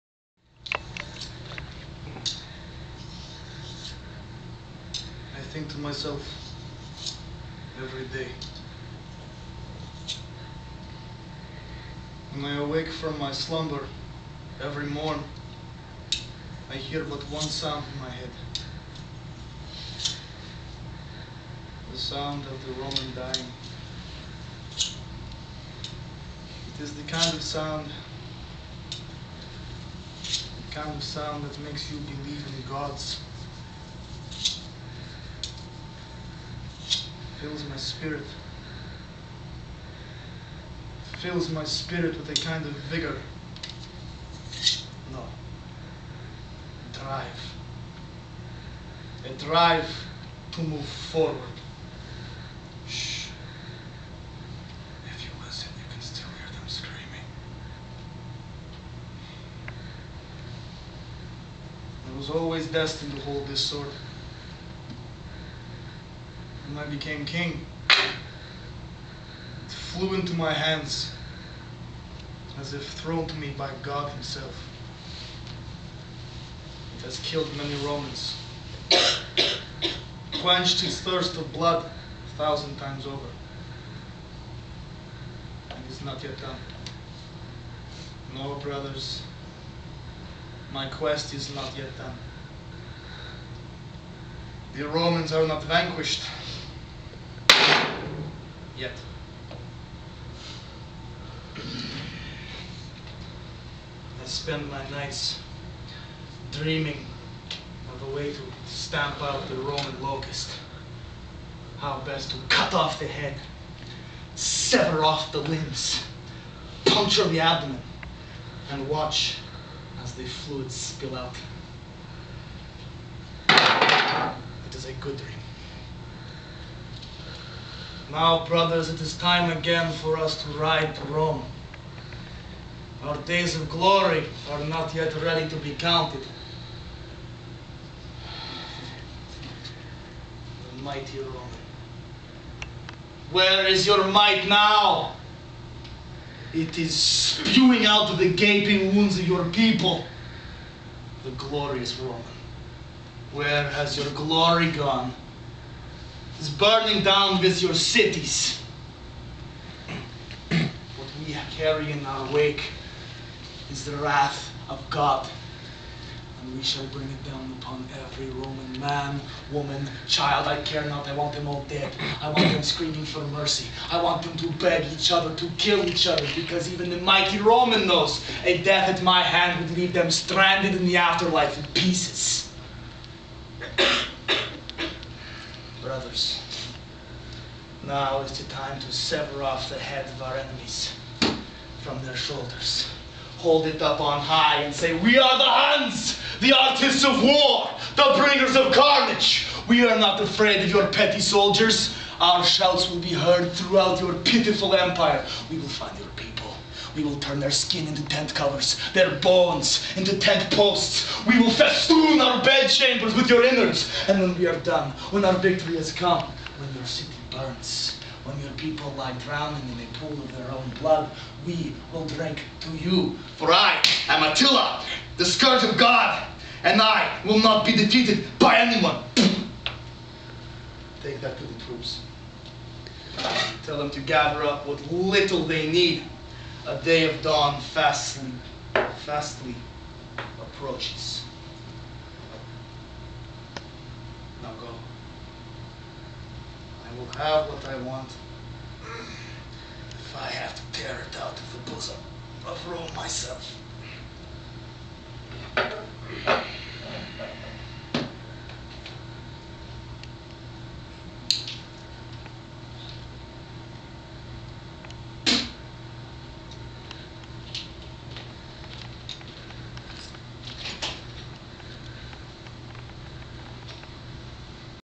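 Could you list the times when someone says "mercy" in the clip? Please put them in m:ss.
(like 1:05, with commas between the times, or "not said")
2:53.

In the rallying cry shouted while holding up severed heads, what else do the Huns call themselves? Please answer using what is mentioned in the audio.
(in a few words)
The artists of war.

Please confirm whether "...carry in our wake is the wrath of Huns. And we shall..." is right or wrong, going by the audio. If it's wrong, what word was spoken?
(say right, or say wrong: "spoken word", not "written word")
wrong: "God", not "Huns".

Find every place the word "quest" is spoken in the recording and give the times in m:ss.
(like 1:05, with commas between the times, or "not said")
1:30.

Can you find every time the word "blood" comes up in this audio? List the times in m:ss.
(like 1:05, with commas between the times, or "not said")
1:21, 3:40.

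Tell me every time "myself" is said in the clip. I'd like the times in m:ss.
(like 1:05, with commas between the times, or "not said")
0:05, 4:12.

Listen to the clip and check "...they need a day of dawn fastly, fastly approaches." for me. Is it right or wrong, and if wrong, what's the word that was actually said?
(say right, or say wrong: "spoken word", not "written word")
right.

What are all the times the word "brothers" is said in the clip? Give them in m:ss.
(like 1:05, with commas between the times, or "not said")
1:28, 2:08, 3:05.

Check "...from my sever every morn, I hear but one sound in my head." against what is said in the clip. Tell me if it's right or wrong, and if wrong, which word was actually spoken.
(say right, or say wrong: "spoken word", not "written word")
wrong: "slumber", not "sever".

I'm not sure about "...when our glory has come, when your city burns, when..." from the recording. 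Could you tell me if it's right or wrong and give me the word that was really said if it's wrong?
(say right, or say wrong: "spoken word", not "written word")
wrong: "victory", not "glory".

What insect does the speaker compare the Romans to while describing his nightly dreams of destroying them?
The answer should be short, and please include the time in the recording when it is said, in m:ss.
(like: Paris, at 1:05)
Locust, at 1:50.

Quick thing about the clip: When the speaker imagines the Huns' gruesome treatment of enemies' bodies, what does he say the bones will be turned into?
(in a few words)
Tent posts.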